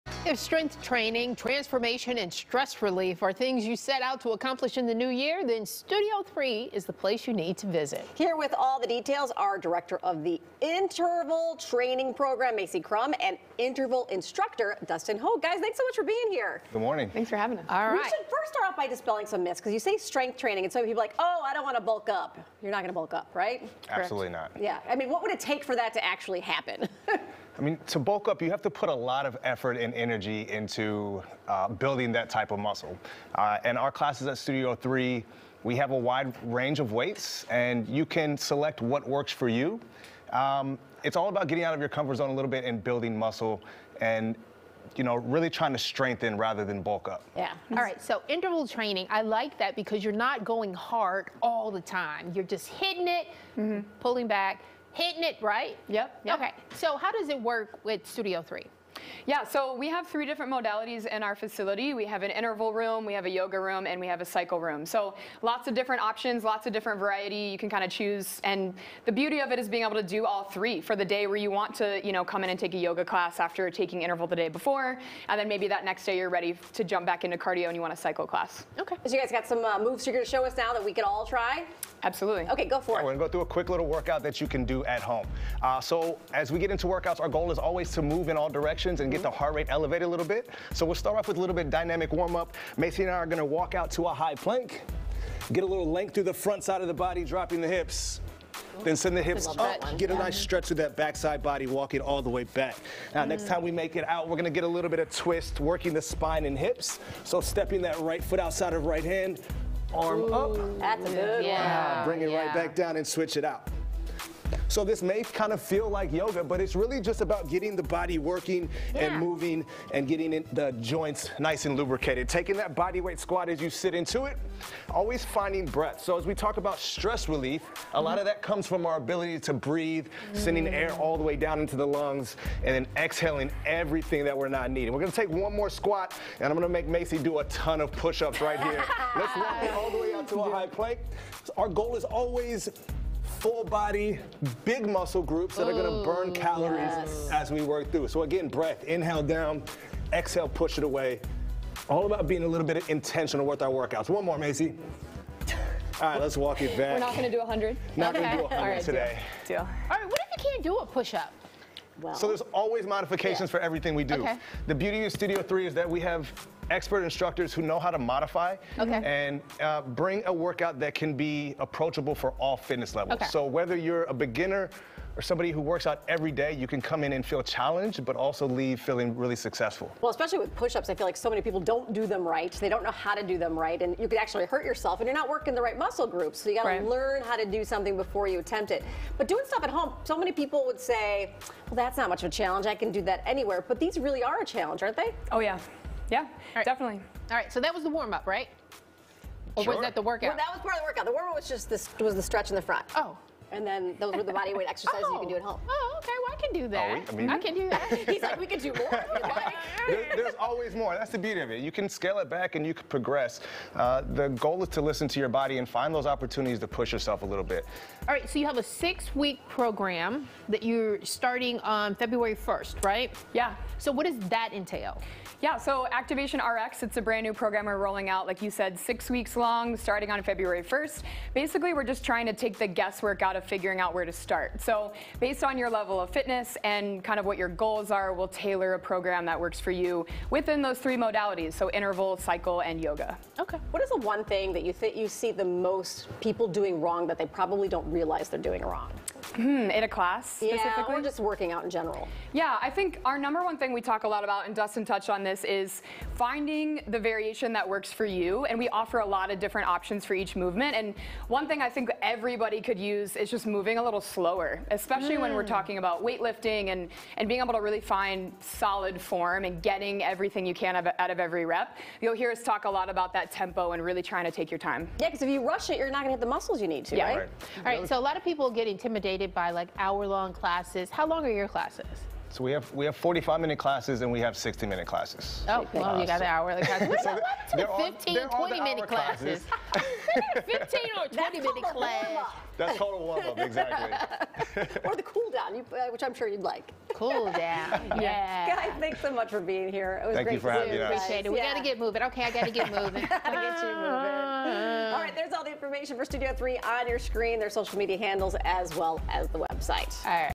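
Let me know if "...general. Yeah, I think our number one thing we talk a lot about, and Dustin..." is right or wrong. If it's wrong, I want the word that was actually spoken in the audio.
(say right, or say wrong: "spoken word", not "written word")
right.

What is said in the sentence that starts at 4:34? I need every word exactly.
Yeah, because if you rush it, you're not going to hit the muscles you need to, yeah.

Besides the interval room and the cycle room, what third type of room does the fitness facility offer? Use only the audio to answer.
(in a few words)
yoga room.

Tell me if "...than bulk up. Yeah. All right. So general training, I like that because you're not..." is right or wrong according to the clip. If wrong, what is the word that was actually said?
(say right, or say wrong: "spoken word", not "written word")
wrong: "interval", not "general".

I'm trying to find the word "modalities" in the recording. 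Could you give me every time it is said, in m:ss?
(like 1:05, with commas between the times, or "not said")
1:00, 4:00.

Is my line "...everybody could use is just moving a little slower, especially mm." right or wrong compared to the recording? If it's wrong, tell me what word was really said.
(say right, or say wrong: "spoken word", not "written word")
right.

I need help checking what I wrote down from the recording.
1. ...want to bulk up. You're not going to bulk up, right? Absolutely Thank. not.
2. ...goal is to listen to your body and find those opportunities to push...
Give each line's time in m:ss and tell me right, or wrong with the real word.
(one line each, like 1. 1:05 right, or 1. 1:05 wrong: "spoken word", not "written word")
1. 0:21 wrong: "Correct", not "Thank"
2. 3:34 right.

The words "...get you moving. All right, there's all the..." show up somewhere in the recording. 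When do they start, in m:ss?
5:03.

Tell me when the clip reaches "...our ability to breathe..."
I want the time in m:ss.
2:08.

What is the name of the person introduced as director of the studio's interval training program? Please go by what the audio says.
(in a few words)
Macie Crumb.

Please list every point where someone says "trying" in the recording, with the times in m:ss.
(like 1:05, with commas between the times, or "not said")
0:45, 3:52, 4:34.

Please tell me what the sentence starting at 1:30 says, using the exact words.
So we'll start off with a little bit of dynamic warm up.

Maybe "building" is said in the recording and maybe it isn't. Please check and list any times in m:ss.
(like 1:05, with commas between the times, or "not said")
0:31, 0:42.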